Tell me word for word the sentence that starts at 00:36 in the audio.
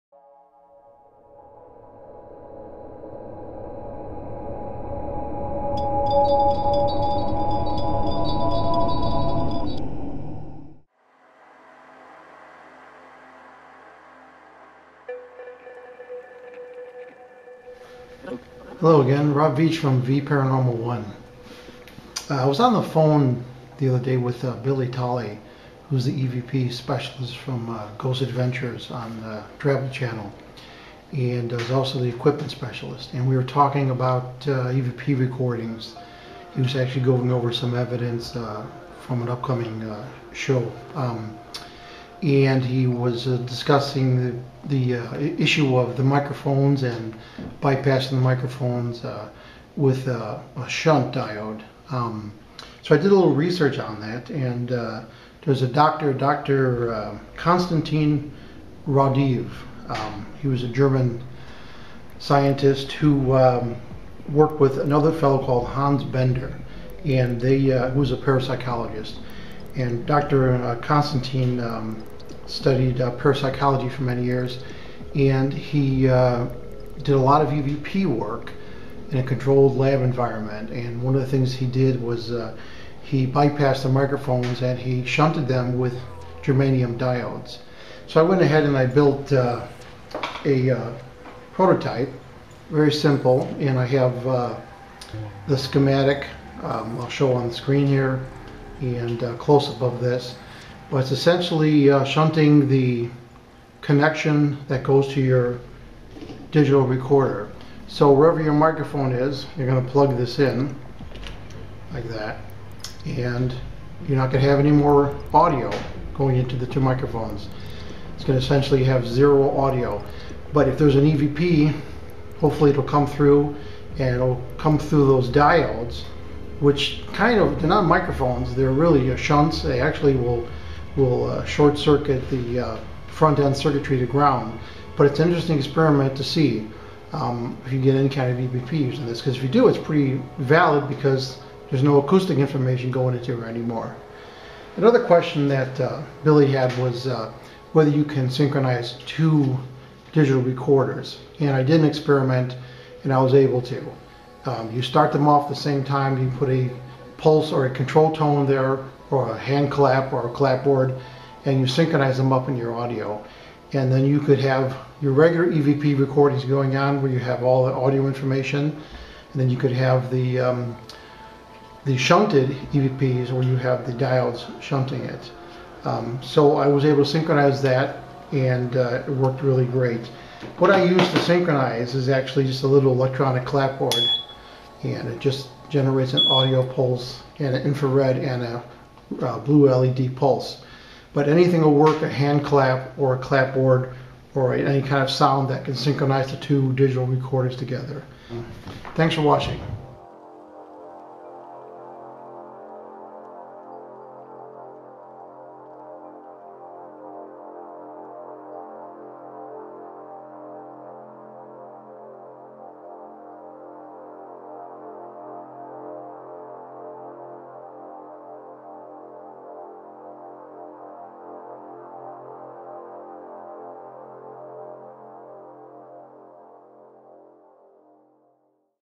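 He was actually going over some evidence uh, from an upcoming show.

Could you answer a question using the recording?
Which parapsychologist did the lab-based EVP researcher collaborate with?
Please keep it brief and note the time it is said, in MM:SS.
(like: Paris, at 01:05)
Hans Bender, at 01:05.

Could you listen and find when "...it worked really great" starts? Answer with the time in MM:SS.
02:59.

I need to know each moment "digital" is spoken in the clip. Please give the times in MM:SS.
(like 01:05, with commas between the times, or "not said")
01:46, 02:30, 03:16.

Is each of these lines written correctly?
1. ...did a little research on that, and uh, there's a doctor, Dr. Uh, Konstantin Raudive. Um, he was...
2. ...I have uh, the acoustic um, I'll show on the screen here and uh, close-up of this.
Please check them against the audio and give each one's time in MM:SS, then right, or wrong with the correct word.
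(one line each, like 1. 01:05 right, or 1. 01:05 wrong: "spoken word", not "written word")
1. 00:52 right
2. 01:33 wrong: "schematic", not "acoustic".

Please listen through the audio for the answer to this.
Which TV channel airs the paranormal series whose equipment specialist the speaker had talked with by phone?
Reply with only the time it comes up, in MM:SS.
00:29.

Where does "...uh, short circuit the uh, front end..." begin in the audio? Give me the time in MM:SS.
02:11.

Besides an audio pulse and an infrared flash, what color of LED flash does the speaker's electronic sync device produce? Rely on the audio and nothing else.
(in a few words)
blue.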